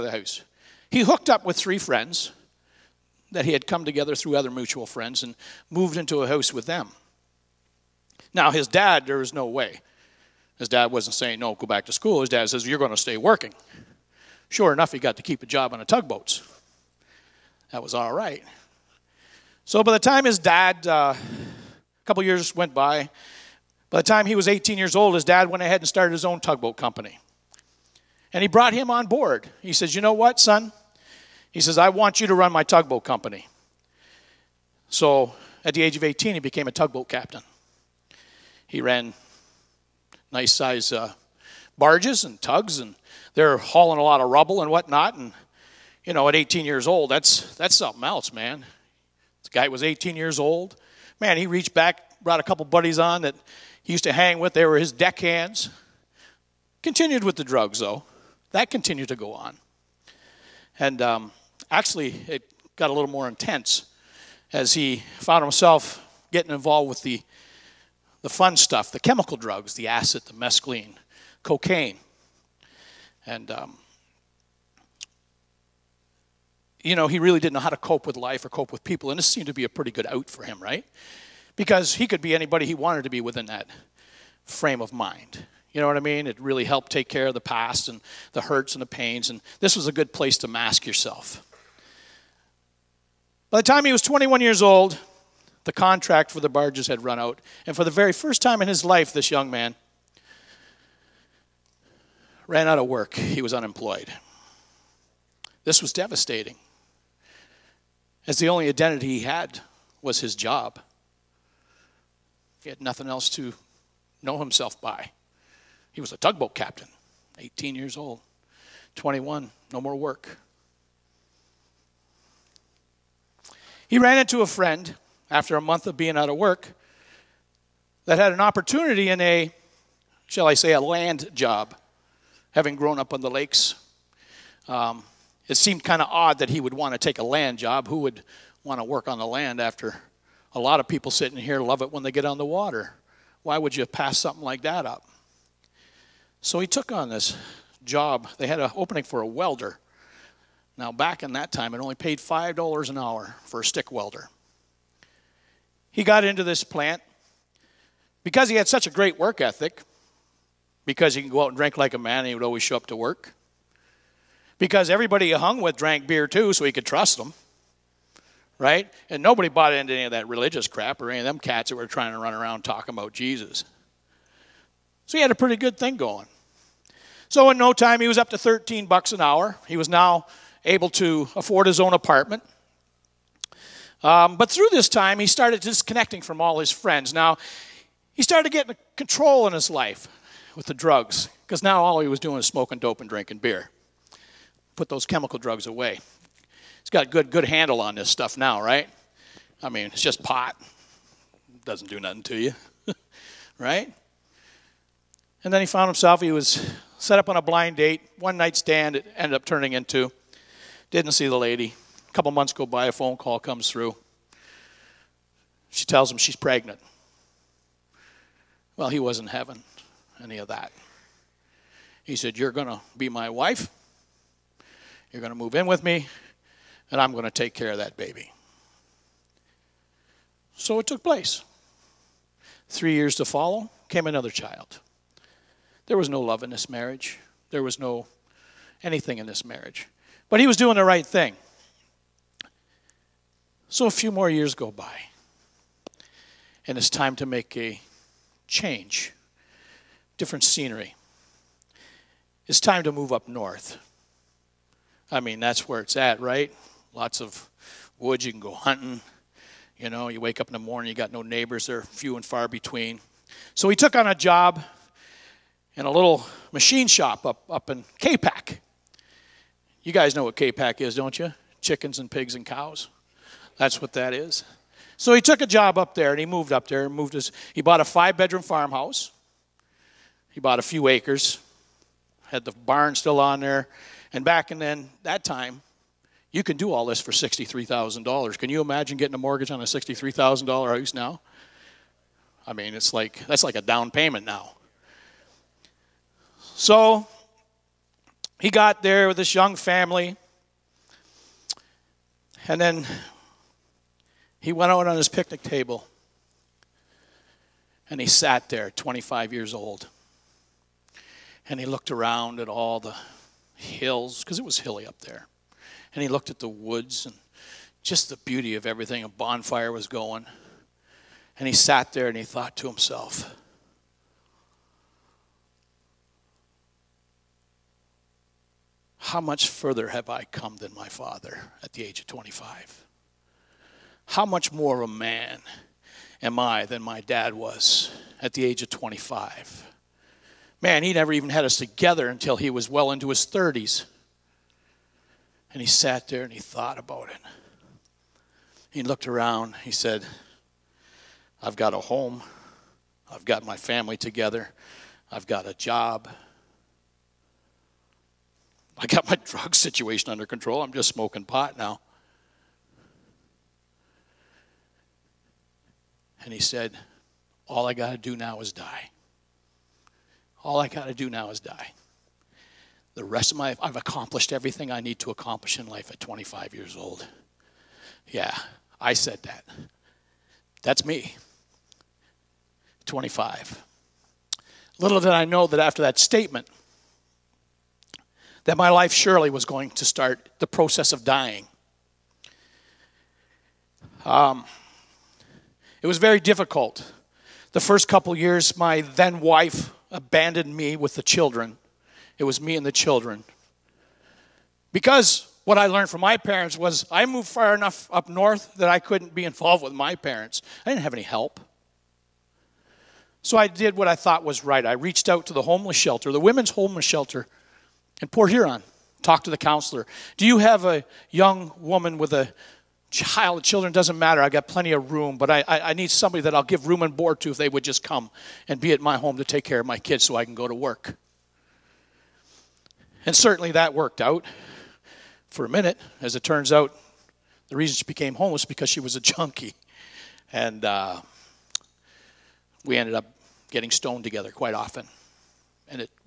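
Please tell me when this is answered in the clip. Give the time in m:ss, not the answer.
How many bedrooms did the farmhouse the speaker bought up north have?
4:37.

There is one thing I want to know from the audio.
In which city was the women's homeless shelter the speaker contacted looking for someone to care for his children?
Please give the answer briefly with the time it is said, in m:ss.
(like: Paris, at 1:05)
Port Huron, at 6:58.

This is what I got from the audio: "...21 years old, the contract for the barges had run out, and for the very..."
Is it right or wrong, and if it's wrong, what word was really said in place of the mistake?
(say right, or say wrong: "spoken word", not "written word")
right.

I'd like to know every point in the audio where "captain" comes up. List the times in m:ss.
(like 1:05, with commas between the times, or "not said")
0:37, 1:56.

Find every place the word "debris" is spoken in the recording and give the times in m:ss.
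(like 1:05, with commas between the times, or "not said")
not said.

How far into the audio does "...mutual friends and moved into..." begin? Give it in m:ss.
0:04.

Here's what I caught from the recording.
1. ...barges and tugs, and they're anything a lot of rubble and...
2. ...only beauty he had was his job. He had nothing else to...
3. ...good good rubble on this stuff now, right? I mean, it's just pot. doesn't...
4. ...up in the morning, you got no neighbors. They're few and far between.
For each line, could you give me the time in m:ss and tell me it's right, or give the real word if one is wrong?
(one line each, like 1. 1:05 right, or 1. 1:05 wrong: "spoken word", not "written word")
1. 0:41 wrong: "hauling", not "anything"
2. 1:48 wrong: "identity", not "beauty"
3. 3:17 wrong: "handle", not "rubble"
4. 4:20 right.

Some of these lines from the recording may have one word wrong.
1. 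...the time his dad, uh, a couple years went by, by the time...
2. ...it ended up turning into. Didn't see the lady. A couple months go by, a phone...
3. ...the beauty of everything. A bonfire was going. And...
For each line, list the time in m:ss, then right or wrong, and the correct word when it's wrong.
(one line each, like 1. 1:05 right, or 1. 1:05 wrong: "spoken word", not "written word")
1. 0:19 right
2. 3:28 right
3. 5:18 right.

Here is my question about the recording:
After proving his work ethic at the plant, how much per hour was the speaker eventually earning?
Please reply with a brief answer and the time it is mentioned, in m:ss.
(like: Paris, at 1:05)
$13, at 2:58.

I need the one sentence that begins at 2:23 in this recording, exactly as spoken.
Why would you pass something like that up?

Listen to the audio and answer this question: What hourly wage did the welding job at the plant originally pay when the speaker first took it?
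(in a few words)
$5.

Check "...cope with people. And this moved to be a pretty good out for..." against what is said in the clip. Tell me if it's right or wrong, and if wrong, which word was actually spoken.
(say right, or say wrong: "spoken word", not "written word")
wrong: "seemed", not "moved".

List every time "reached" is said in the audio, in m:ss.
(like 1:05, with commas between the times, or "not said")
0:51, 6:54.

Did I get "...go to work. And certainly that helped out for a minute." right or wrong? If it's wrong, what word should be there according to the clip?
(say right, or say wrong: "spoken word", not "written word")
wrong: "worked", not "helped".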